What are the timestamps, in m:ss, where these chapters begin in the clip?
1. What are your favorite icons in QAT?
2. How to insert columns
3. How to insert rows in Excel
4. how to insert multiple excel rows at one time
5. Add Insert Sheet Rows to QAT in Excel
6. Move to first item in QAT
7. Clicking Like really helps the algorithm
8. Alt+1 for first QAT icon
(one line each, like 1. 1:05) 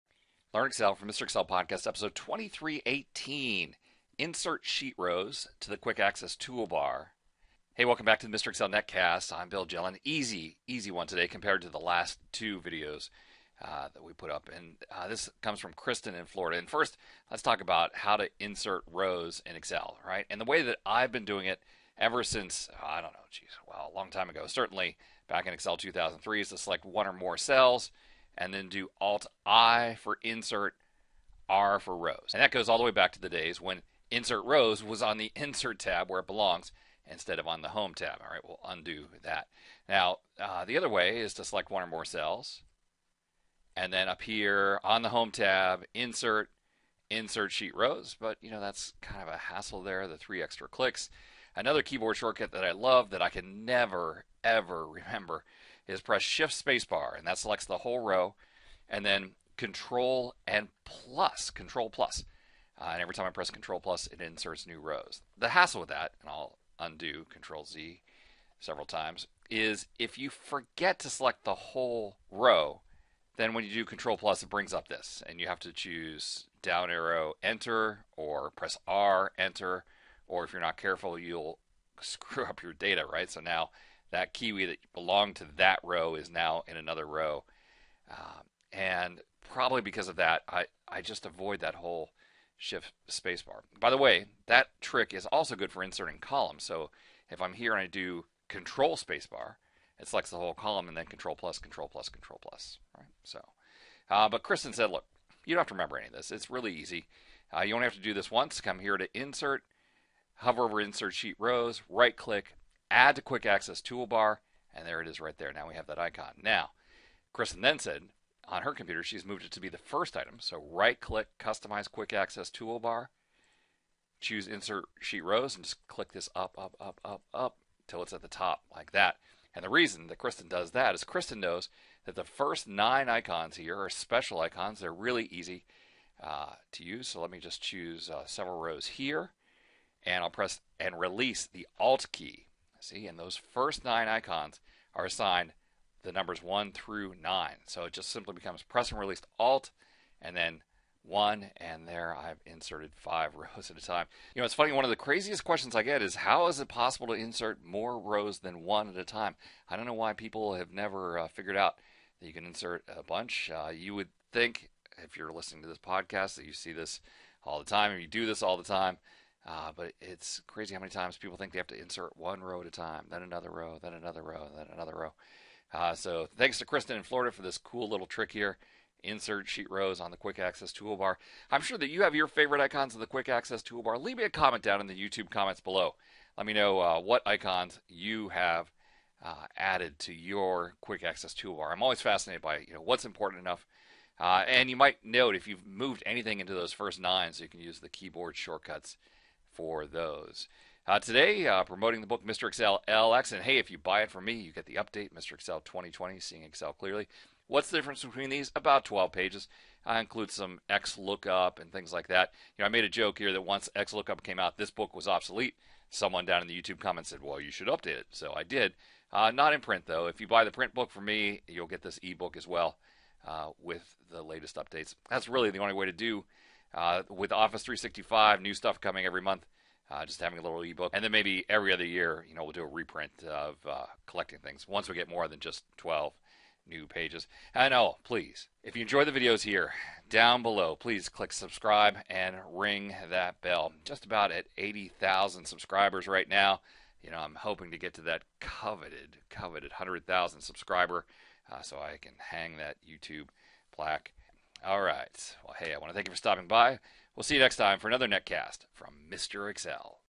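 1. 3:05
2. 1:39
3. 0:20
4. 2:40
5. 1:49
6. 2:05
7. 3:23
8. 2:16.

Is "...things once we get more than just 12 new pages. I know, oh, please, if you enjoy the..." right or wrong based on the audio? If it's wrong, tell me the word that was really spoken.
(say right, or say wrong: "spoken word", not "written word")
right.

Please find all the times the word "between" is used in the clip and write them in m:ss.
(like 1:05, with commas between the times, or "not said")
3:28.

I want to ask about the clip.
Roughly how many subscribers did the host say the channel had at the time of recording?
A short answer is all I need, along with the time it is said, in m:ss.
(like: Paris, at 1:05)
80,000, at 4:04.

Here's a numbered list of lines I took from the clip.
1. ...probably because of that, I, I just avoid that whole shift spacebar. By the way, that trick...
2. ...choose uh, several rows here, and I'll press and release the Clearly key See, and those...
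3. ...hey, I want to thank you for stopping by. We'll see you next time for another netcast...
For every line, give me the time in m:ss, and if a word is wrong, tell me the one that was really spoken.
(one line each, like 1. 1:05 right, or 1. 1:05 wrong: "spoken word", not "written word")
1. 1:29 right
2. 2:17 wrong: "Alt", not "Clearly"
3. 4:15 right.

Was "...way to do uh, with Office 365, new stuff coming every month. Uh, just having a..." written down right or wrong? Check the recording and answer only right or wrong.
right.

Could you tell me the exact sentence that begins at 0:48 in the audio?
But you know, that's kind of a hassle there, the three extra clicks.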